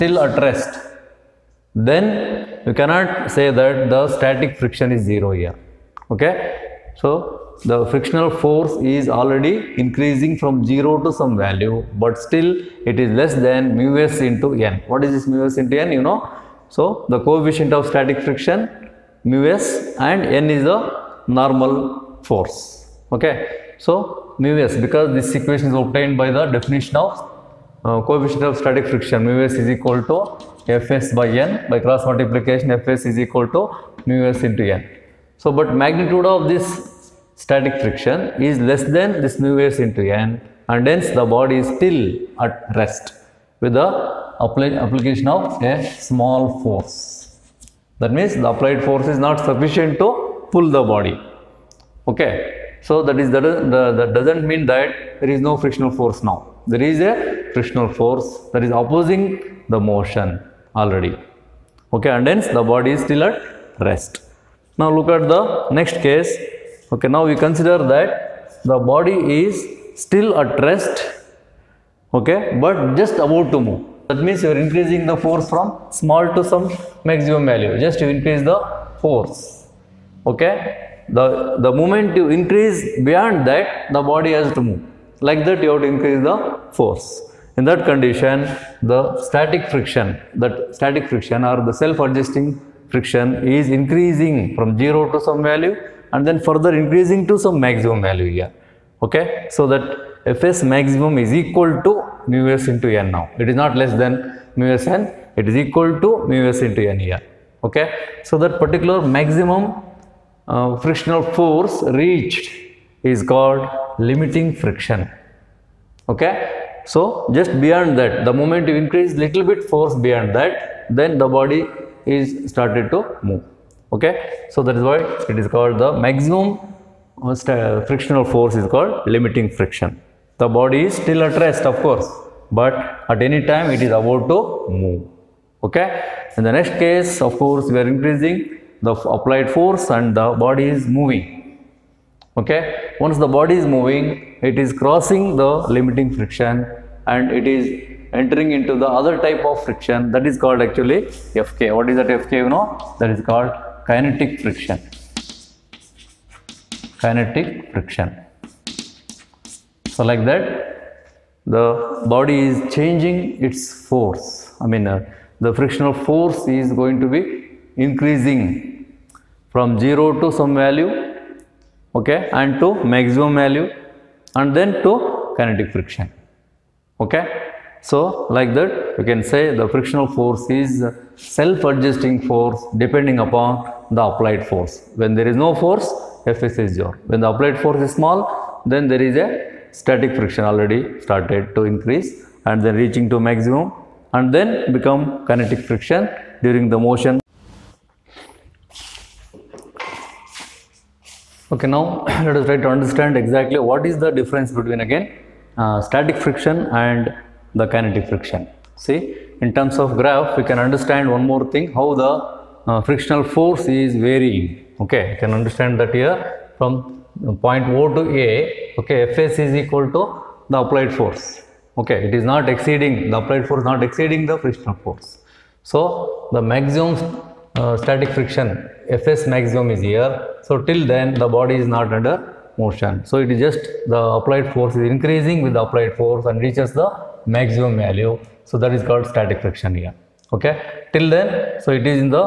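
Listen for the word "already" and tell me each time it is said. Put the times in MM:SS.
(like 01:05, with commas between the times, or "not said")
00:09, 01:00, 03:10.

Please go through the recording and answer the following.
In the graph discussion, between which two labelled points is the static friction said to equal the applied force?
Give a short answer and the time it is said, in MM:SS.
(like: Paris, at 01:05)
O to A, at 03:37.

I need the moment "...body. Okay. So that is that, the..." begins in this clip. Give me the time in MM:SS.
00:50.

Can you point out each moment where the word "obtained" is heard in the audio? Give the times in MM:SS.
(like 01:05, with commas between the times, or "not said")
00:25.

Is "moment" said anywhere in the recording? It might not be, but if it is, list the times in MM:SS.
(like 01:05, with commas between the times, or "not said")
01:21, 01:58.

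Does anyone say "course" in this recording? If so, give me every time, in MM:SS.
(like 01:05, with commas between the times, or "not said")
02:11, 02:17.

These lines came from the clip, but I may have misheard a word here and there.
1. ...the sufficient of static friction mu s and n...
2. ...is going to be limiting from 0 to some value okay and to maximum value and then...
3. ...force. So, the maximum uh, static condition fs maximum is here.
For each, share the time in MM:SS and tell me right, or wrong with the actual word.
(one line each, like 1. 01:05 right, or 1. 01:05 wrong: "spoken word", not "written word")
1. 00:17 wrong: "coefficient", not "sufficient"
2. 02:46 wrong: "increasing", not "limiting"
3. 03:44 wrong: "friction", not "condition".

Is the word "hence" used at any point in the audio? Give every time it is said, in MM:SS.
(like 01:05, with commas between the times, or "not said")
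00:40, 01:02.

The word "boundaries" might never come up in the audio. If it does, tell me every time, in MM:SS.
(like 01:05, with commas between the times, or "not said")
not said.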